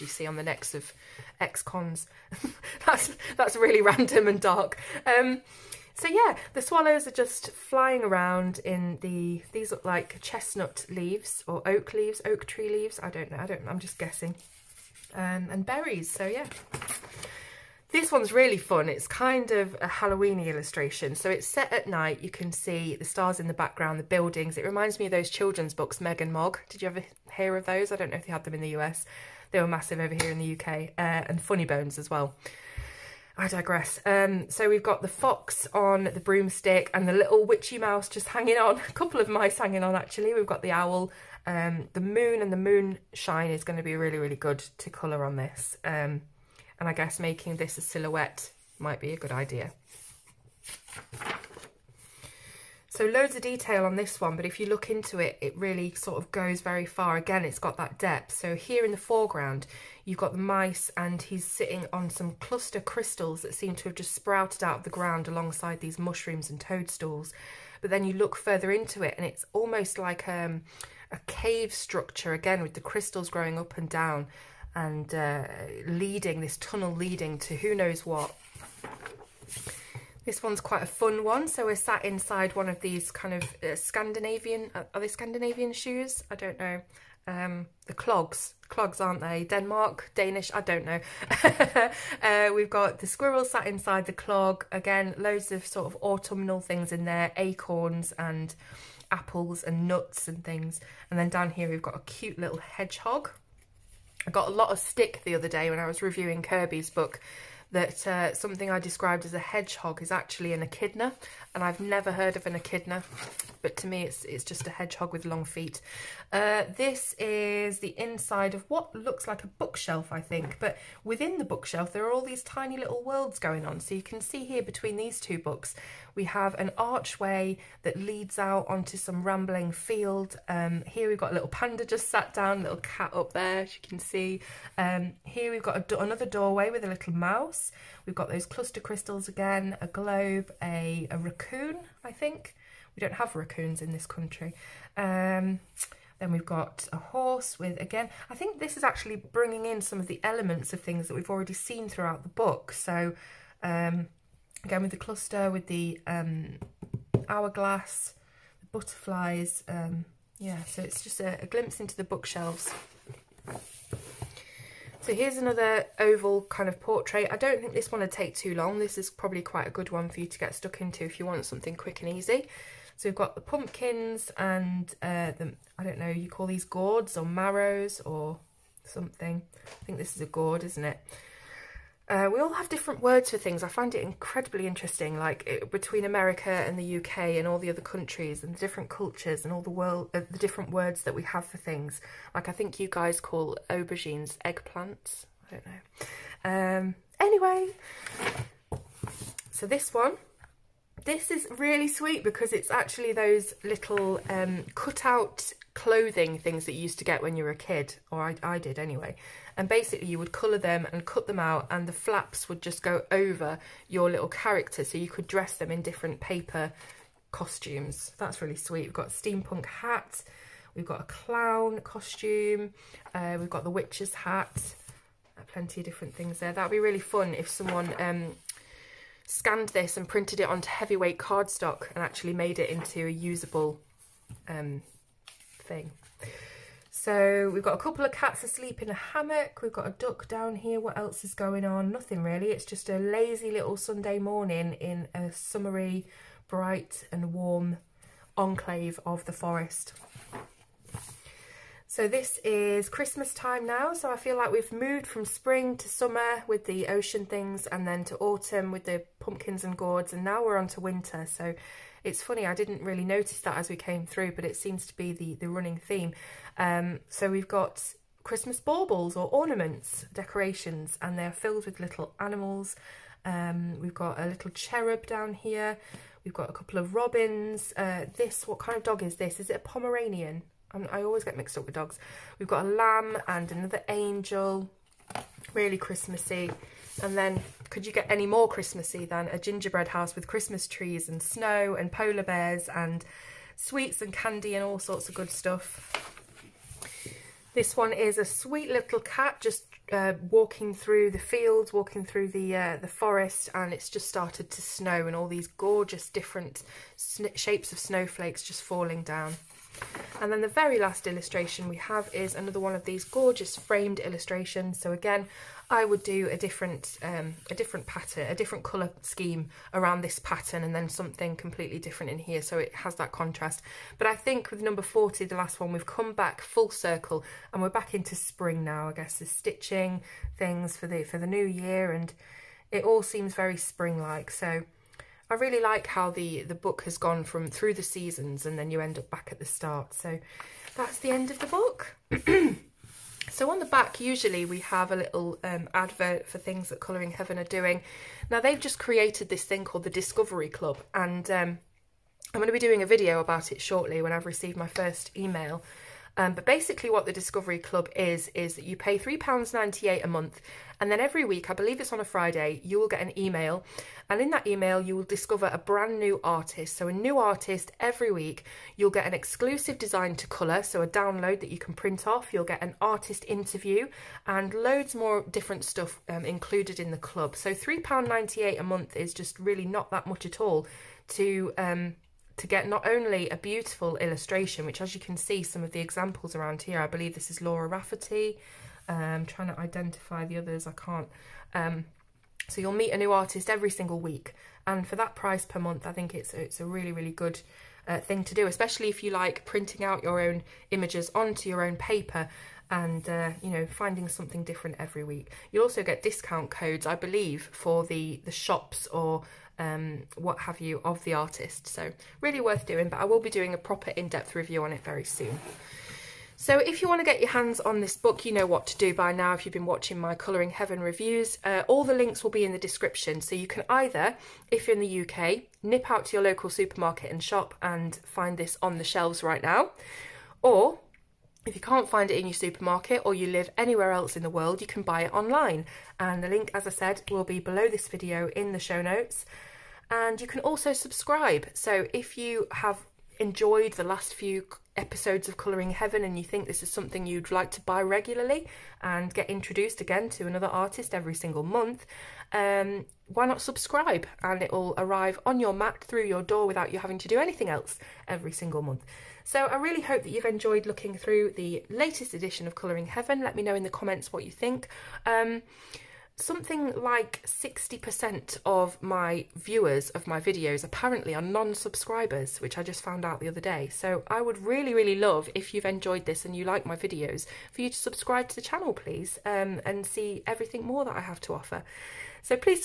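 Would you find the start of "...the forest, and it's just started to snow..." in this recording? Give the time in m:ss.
5:02.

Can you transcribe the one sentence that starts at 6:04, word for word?
And in that email, you will discover a brand new artist.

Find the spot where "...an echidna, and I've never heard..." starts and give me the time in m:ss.
1:50.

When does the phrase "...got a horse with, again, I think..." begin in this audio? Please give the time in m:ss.
2:26.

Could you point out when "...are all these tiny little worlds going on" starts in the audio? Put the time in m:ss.
2:02.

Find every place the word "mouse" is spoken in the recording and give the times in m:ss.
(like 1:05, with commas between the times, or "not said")
0:37, 2:17.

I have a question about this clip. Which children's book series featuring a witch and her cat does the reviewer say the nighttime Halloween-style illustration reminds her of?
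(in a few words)
Meg and Mog.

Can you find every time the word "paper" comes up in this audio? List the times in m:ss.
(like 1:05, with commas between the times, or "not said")
3:36, 6:41.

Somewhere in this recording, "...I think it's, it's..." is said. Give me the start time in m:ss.
6:35.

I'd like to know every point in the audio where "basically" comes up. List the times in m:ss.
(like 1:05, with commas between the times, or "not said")
3:29, 5:56.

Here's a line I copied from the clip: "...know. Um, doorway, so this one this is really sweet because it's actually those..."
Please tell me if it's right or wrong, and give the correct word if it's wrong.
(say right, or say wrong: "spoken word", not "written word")
wrong: "anyway", not "doorway".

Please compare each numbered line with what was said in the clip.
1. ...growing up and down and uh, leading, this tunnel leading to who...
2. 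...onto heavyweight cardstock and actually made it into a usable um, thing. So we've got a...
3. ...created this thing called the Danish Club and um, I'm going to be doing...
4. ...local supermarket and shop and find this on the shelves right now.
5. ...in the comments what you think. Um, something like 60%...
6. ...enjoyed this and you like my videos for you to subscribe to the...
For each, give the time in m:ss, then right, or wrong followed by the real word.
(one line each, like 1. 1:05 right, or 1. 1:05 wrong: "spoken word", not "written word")
1. 1:13 right
2. 3:50 right
3. 5:48 wrong: "Discovery", not "Danish"
4. 7:06 right
5. 7:43 right
6. 7:55 right.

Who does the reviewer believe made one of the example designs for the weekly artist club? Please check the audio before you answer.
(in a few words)
Laura Rafferty.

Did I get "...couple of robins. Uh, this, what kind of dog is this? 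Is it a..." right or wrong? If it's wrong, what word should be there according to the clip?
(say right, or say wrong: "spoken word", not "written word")
right.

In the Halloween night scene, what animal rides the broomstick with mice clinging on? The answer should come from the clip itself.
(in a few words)
Fox.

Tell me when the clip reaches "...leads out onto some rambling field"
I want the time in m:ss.
2:07.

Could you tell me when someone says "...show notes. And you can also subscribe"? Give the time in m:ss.
7:18.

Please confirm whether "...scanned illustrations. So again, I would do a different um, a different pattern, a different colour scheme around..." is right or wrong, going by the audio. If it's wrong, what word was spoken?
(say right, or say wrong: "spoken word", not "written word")
wrong: "framed", not "scanned".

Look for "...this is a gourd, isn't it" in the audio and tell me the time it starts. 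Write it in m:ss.
2:59.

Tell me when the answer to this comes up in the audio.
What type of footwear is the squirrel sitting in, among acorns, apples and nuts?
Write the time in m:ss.
1:34.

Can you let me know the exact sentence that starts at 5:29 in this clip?
The stitching things for the, for the new year and it all seems very spring-like.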